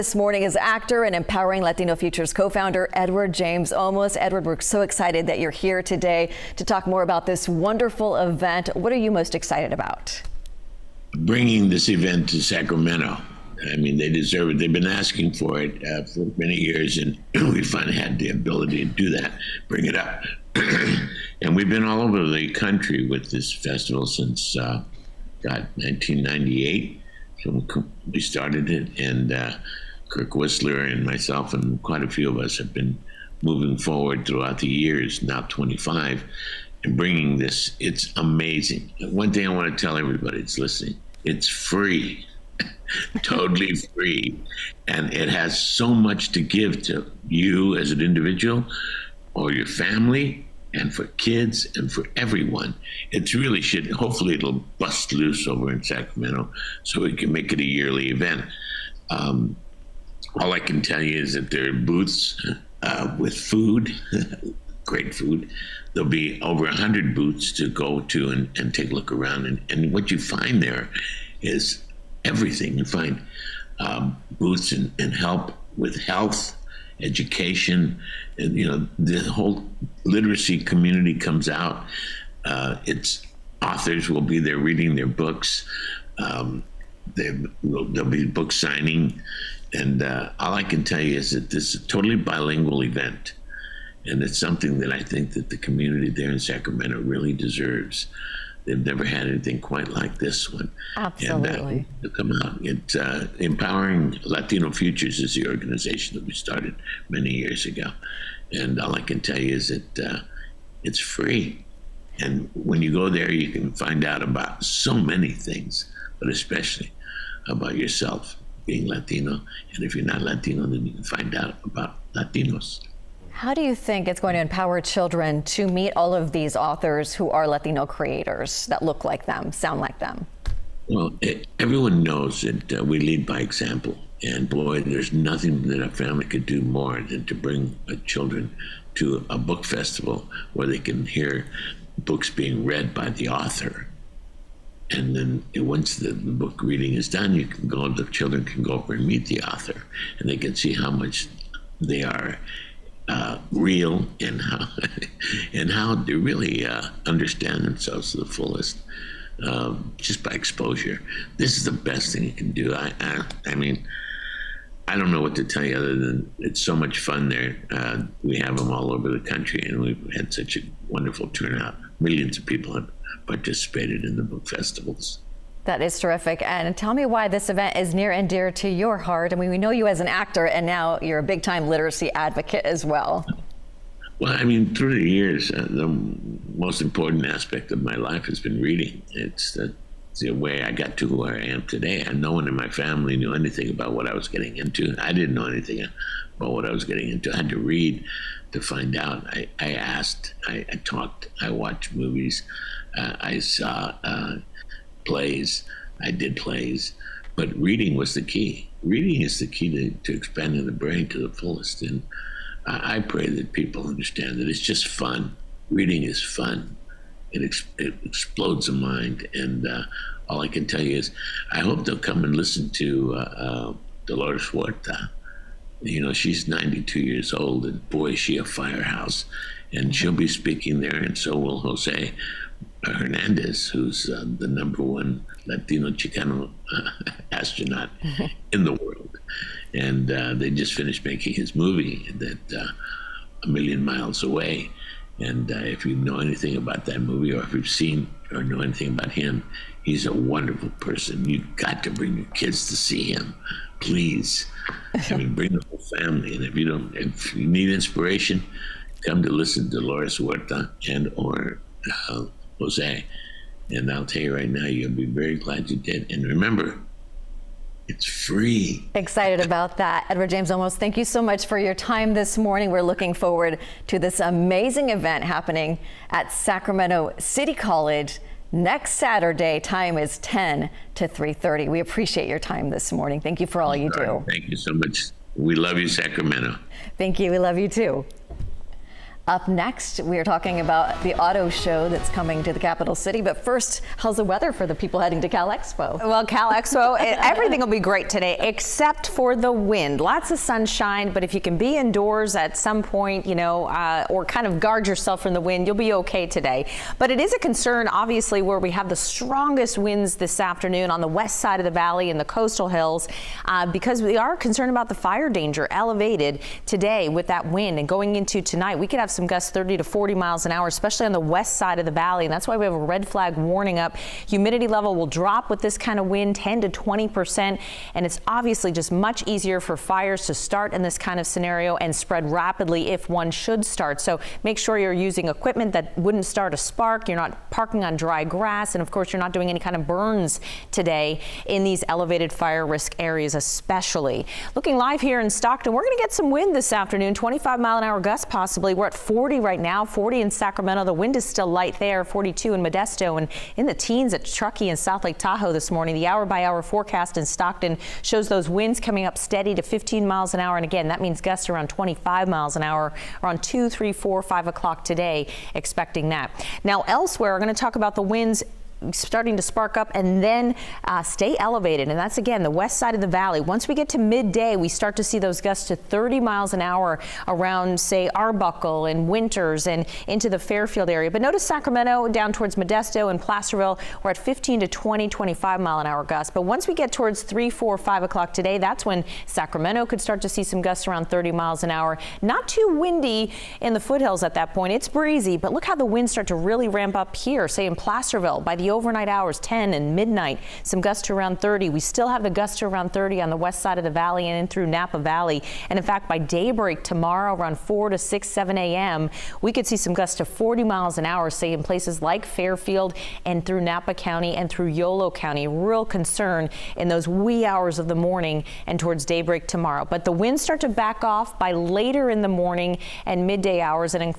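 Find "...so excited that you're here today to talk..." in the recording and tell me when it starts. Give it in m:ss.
0:04.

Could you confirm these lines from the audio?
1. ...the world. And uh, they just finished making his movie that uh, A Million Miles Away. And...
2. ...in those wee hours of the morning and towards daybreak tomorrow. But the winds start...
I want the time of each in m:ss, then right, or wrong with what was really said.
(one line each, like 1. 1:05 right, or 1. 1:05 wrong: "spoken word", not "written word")
1. 3:58 right
2. 6:56 right.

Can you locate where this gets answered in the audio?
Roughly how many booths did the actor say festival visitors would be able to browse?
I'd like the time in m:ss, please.
1:06.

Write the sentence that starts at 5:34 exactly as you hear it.
So make sure you're using equipment that wouldn't start a spark.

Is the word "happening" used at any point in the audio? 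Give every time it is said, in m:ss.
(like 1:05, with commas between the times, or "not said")
4:35.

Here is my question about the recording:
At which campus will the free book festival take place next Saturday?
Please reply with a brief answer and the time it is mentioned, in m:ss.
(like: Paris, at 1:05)
Sacramento City College, at 4:36.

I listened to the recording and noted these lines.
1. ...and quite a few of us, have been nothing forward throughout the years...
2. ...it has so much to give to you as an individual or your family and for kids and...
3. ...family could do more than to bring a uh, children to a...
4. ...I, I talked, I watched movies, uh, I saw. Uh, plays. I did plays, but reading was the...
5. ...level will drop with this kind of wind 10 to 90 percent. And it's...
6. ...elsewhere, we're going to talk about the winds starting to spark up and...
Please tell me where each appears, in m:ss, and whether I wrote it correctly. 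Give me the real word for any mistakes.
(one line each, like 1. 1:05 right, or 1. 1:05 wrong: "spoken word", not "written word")
1. 0:31 wrong: "moving", not "nothing"
2. 0:45 right
3. 2:15 right
4. 3:20 right
5. 5:24 wrong: "20", not "90"
6. 6:06 right.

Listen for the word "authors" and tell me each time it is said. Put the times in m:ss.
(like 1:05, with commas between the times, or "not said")
1:23, 2:06, 2:23, 2:29.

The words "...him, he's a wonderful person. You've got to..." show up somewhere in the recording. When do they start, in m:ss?
4:09.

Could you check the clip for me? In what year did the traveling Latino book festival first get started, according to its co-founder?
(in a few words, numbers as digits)
1998.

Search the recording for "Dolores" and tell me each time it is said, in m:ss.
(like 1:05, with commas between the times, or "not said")
3:44, 4:19.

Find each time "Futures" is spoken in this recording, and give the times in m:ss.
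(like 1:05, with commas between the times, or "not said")
0:01, 1:44.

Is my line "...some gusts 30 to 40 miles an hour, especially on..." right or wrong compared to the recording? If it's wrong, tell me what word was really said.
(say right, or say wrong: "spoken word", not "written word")
right.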